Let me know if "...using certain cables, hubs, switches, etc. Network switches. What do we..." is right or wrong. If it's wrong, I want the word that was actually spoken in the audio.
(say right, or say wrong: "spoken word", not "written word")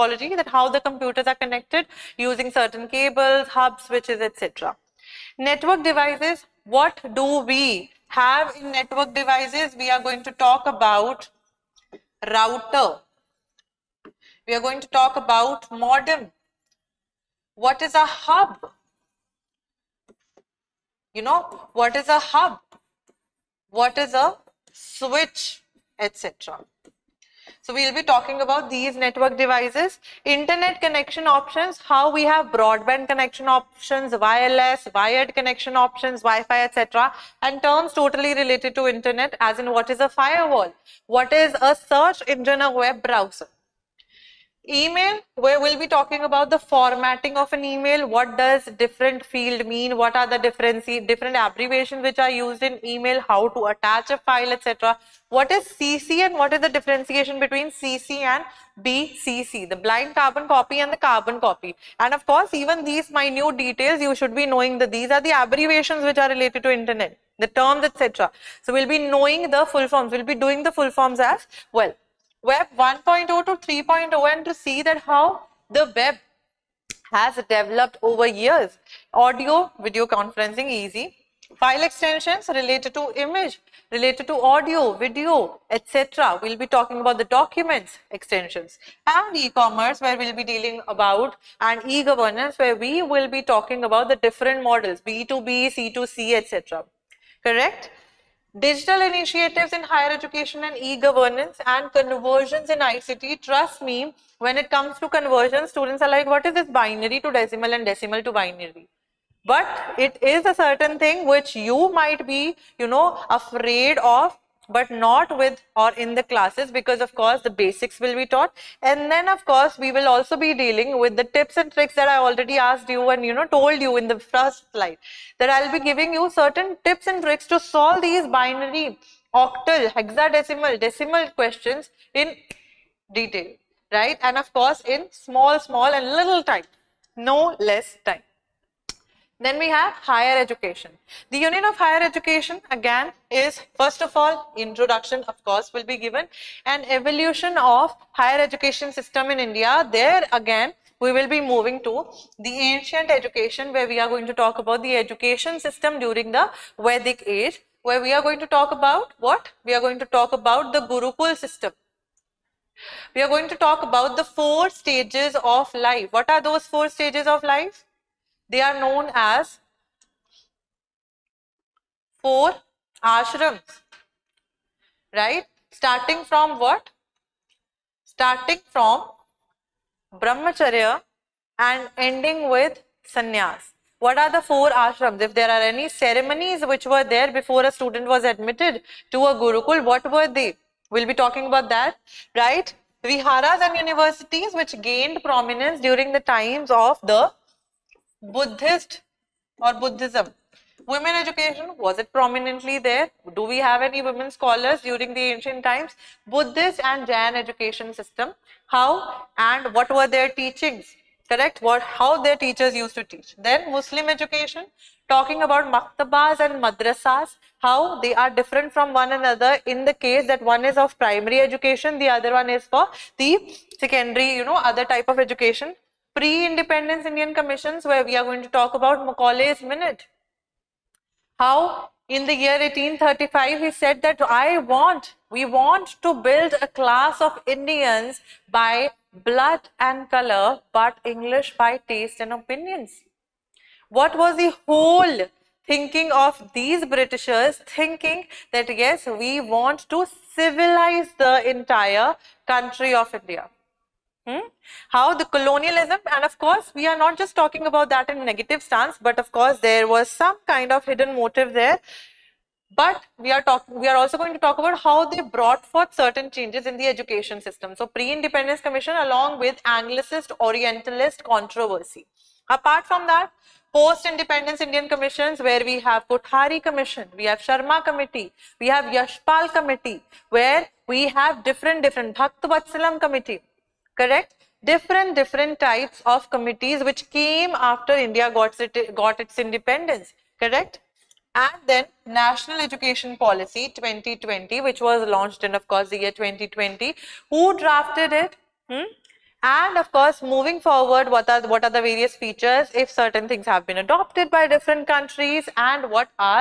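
wrong: "devices", not "switches".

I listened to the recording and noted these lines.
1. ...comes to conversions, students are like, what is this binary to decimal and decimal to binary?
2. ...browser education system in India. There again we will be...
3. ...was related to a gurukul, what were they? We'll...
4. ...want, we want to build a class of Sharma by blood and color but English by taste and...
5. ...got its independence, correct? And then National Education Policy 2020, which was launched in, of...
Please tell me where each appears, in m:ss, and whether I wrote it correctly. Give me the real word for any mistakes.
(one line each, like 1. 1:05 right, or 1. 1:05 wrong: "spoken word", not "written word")
1. 1:44 right
2. 2:28 wrong: "higher", not "browser"
3. 3:08 wrong: "admitted", not "related"
4. 3:54 wrong: "Indians", not "Sharma"
5. 4:48 right.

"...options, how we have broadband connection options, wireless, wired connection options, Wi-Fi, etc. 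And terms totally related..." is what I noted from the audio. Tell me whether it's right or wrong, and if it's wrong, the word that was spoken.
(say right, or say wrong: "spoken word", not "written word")
right.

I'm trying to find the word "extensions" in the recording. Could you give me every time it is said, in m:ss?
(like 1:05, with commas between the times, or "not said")
1:21, 1:28.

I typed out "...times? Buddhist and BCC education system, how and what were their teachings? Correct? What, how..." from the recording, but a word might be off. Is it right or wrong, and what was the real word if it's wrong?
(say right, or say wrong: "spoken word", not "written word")
wrong: "Jain", not "BCC".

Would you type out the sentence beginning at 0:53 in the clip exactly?
How to attach a file, etc.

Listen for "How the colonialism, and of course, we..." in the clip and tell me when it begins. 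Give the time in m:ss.
4:14.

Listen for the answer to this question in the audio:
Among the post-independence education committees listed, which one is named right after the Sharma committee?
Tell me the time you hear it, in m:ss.
4:38.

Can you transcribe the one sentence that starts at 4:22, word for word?
But we are talking, we are also going to talk about how they brought forth certain changes in the education system.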